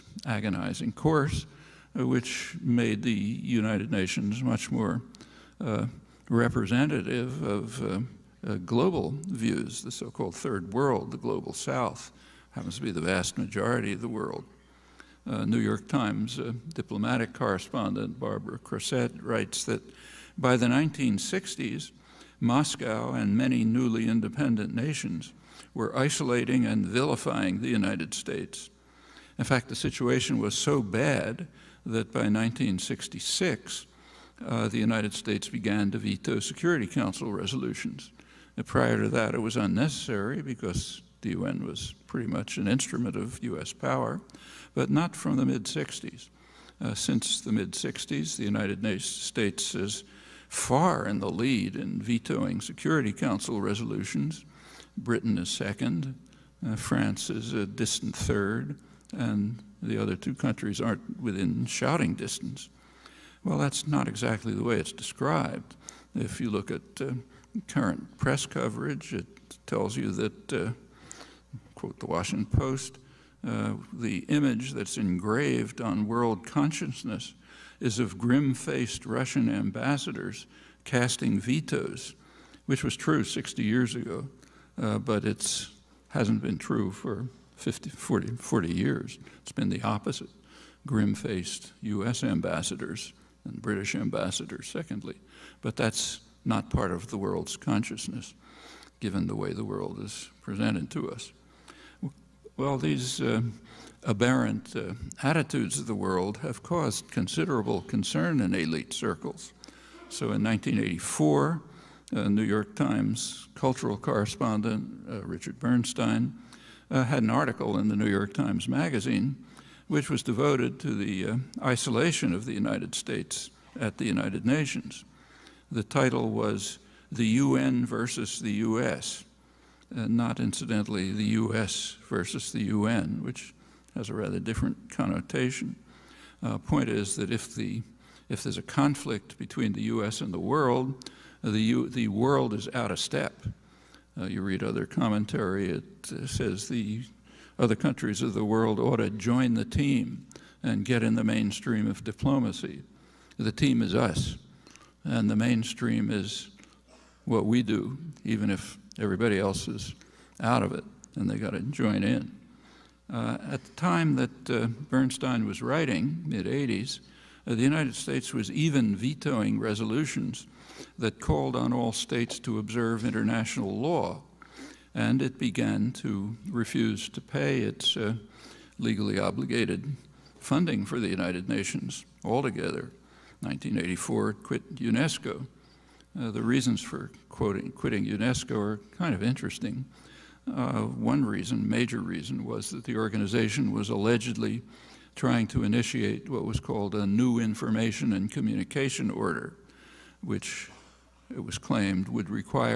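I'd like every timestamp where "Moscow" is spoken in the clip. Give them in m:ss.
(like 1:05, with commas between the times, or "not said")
0:22.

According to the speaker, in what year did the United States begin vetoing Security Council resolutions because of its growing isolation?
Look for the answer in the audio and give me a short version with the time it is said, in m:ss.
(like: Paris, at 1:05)
1966, at 0:32.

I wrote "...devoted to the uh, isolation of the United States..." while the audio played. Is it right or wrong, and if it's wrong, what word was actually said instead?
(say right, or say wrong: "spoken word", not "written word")
right.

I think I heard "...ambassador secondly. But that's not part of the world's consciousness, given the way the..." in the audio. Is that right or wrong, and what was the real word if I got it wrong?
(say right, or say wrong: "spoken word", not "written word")
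right.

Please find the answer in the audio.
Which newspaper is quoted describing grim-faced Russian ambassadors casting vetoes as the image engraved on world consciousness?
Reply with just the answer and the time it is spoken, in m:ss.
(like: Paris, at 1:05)
Washington Post, at 1:12.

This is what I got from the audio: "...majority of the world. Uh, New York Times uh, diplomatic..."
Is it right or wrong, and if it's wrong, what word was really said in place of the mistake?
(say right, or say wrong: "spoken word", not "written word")
right.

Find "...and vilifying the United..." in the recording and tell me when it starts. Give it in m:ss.
0:26.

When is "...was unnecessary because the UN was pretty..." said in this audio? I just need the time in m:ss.
0:39.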